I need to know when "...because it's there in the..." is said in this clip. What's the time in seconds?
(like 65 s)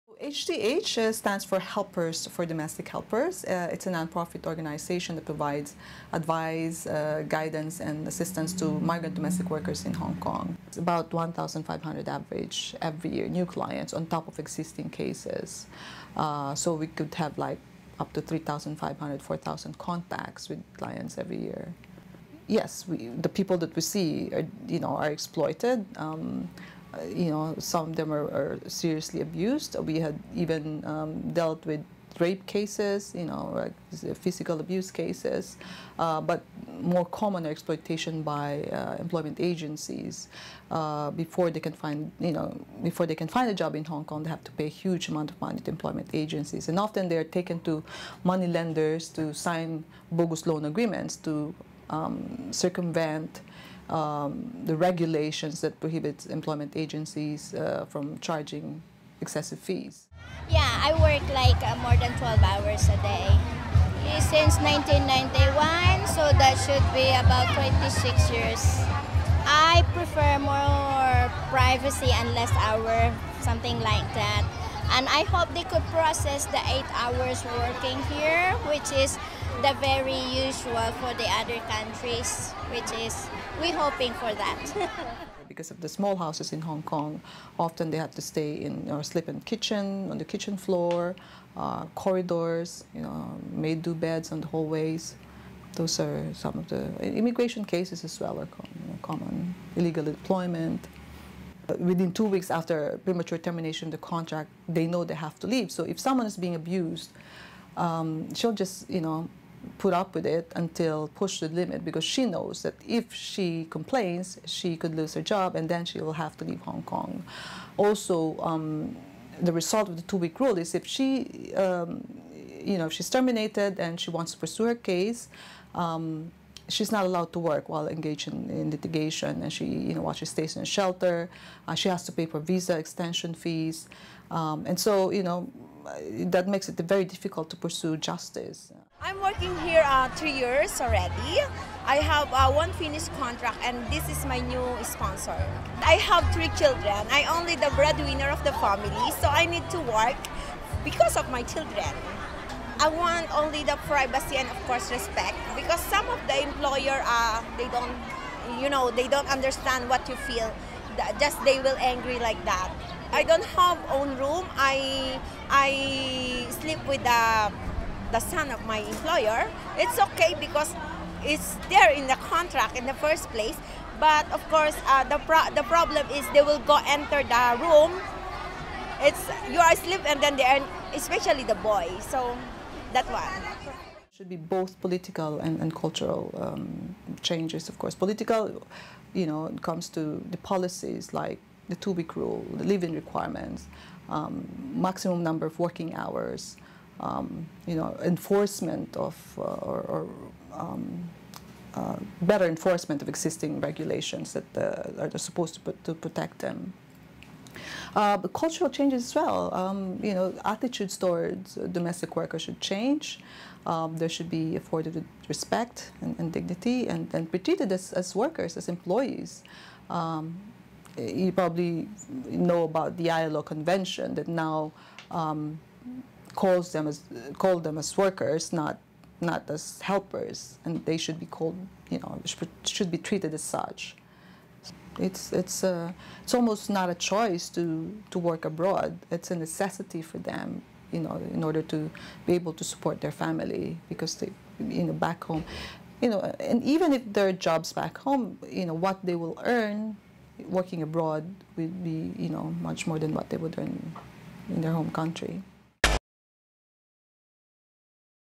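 170 s.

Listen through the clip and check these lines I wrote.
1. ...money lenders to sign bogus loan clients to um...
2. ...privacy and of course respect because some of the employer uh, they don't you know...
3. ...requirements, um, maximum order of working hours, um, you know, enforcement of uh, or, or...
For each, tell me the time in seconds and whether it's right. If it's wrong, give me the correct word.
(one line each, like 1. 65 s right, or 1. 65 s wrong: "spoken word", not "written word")
1. 48 s wrong: "agreements", not "clients"
2. 153 s right
3. 192 s wrong: "number", not "order".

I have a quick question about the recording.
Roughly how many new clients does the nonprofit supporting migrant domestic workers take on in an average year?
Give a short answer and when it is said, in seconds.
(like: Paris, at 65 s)
1,500, at 11 s.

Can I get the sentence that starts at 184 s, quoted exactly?
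Should be both political and, and cultural um, changes, of course.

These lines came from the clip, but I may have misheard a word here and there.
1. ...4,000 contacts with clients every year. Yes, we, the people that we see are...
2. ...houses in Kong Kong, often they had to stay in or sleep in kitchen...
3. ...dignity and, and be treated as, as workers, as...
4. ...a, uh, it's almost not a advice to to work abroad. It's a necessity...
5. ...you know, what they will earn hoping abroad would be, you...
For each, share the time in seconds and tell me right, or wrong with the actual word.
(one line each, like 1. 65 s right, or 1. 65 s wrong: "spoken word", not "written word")
1. 19 s right
2. 86 s wrong: "Hong", not "Kong"
3. 216 s right
4. 235 s wrong: "choice", not "advice"
5. 248 s wrong: "working", not "hoping".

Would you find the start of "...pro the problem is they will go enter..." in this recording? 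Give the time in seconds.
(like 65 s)
175 s.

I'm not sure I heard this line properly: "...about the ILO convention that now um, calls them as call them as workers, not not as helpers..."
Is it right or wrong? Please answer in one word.
right.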